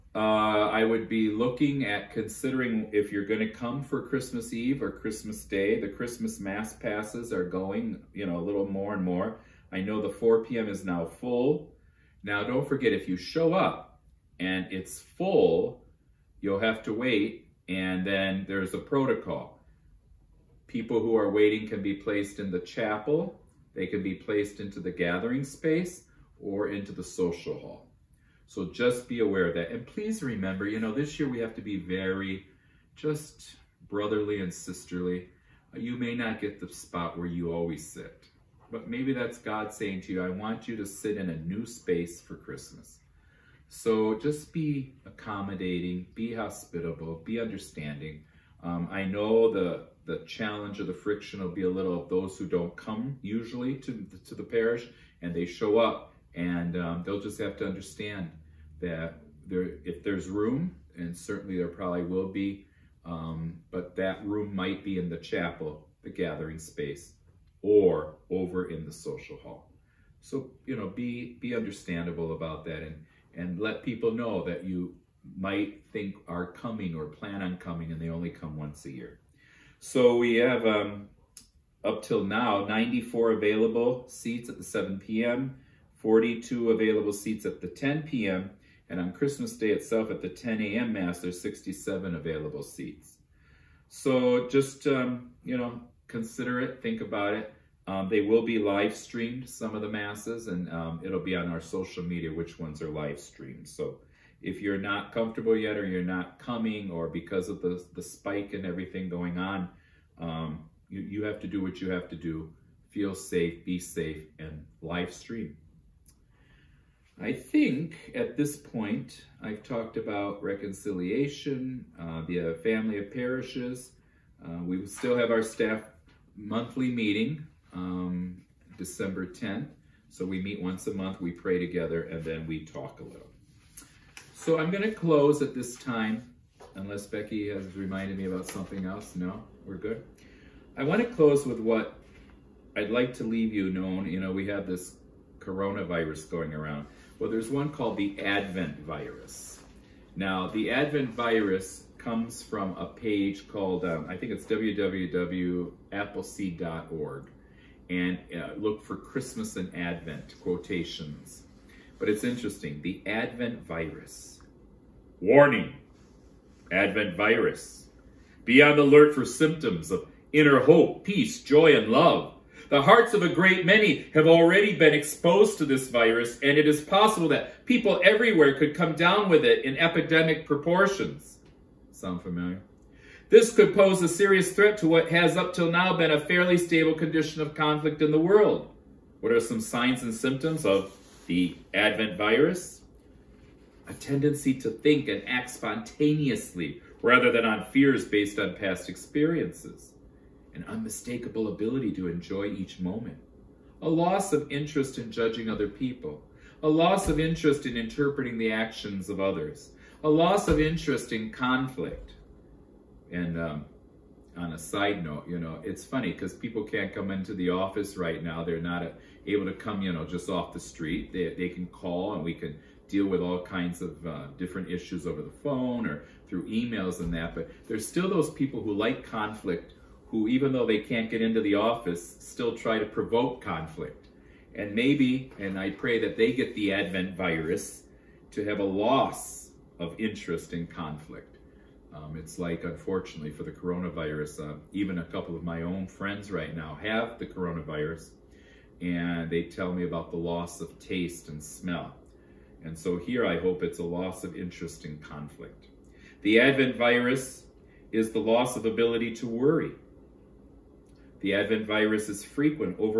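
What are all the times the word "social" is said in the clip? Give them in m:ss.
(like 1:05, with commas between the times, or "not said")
0:27, 1:08, 1:41.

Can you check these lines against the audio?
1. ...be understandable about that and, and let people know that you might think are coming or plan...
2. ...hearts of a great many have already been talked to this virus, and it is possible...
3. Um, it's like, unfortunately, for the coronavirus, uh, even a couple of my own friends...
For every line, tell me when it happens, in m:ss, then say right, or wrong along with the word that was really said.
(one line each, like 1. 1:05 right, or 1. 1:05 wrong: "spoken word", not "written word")
1. 1:11 right
2. 2:52 wrong: "exposed", not "talked"
3. 4:01 right.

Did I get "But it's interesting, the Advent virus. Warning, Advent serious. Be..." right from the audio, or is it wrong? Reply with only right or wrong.
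wrong.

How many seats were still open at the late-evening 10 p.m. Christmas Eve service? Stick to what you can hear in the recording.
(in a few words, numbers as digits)
42.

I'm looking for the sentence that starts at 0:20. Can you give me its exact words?
People who are waiting can be placed in the chapel.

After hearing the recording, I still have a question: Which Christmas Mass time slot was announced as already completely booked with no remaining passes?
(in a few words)
4 p.m.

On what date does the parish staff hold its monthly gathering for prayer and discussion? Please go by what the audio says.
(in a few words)
December 10th.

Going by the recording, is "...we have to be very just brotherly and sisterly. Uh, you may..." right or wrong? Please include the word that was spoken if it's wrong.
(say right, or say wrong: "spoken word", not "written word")
right.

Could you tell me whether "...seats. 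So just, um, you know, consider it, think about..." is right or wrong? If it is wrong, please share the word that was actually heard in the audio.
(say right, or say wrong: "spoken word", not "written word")
right.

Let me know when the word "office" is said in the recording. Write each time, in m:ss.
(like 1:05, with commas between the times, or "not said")
3:37, 3:51.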